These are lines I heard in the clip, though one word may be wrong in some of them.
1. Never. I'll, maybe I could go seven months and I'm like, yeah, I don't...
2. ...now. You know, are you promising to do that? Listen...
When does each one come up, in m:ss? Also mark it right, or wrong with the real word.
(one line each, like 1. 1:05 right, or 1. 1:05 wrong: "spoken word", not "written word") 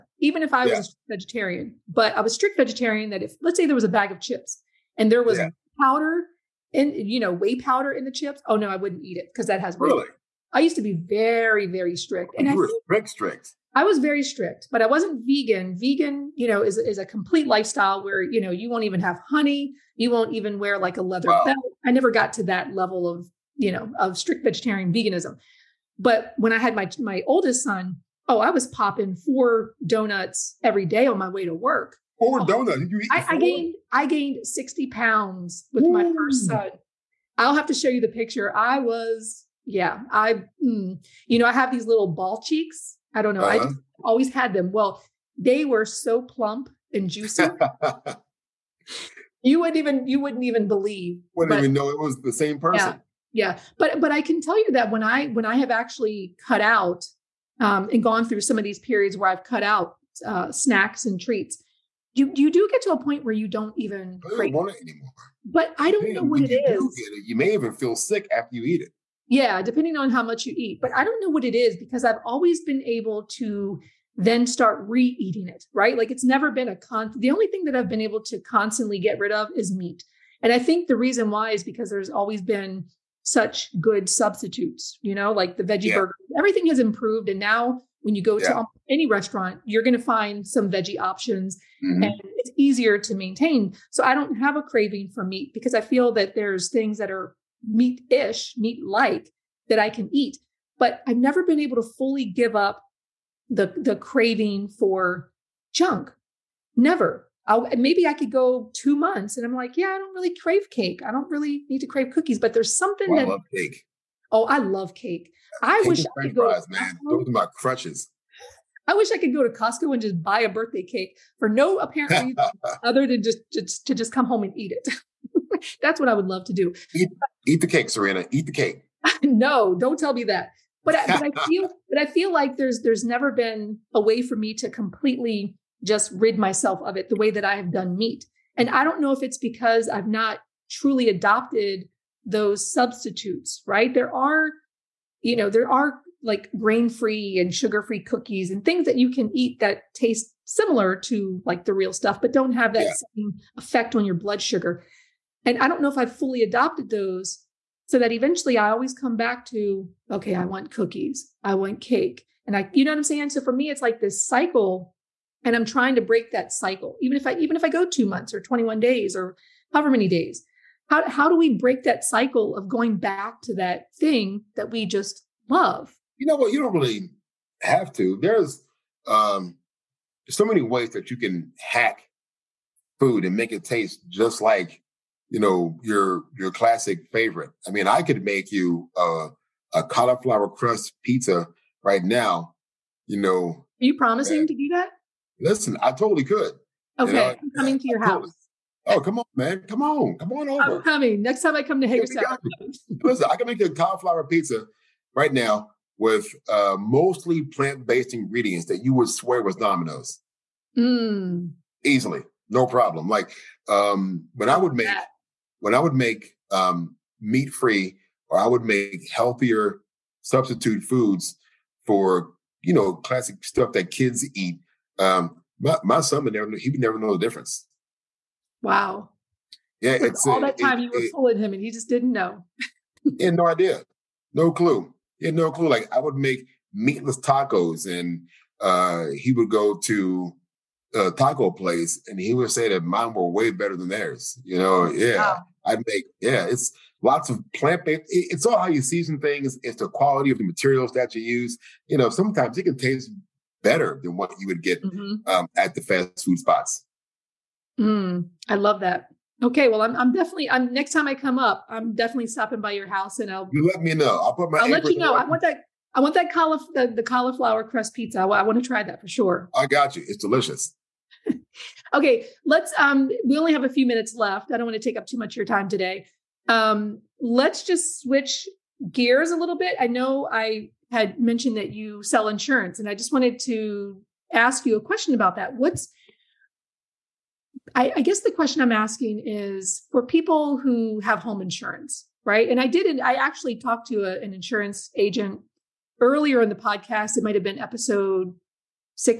1. 1:46 wrong: "two", not "seven"
2. 3:12 right.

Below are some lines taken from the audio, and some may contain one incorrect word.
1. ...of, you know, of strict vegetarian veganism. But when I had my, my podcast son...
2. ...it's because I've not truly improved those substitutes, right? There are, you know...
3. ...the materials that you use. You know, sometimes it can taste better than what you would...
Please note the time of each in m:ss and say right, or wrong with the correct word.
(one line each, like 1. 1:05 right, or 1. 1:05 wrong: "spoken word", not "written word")
1. 0:23 wrong: "oldest", not "podcast"
2. 2:19 wrong: "adopted", not "improved"
3. 4:10 right.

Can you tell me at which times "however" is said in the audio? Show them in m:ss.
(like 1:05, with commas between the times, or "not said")
2:49.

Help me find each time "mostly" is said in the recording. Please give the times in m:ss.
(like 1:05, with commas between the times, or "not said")
3:26.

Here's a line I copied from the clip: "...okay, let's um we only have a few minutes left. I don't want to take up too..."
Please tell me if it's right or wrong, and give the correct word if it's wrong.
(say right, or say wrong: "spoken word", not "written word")
right.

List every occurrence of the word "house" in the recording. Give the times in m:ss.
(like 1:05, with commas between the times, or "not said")
3:18, 4:22.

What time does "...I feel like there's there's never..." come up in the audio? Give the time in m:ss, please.
2:12.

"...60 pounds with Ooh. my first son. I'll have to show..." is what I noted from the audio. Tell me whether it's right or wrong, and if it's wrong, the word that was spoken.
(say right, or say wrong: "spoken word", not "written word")
right.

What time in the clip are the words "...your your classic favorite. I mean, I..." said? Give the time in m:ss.
3:05.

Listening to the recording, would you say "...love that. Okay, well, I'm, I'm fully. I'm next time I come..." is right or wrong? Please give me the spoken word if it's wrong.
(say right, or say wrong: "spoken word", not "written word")
wrong: "definitely", not "fully".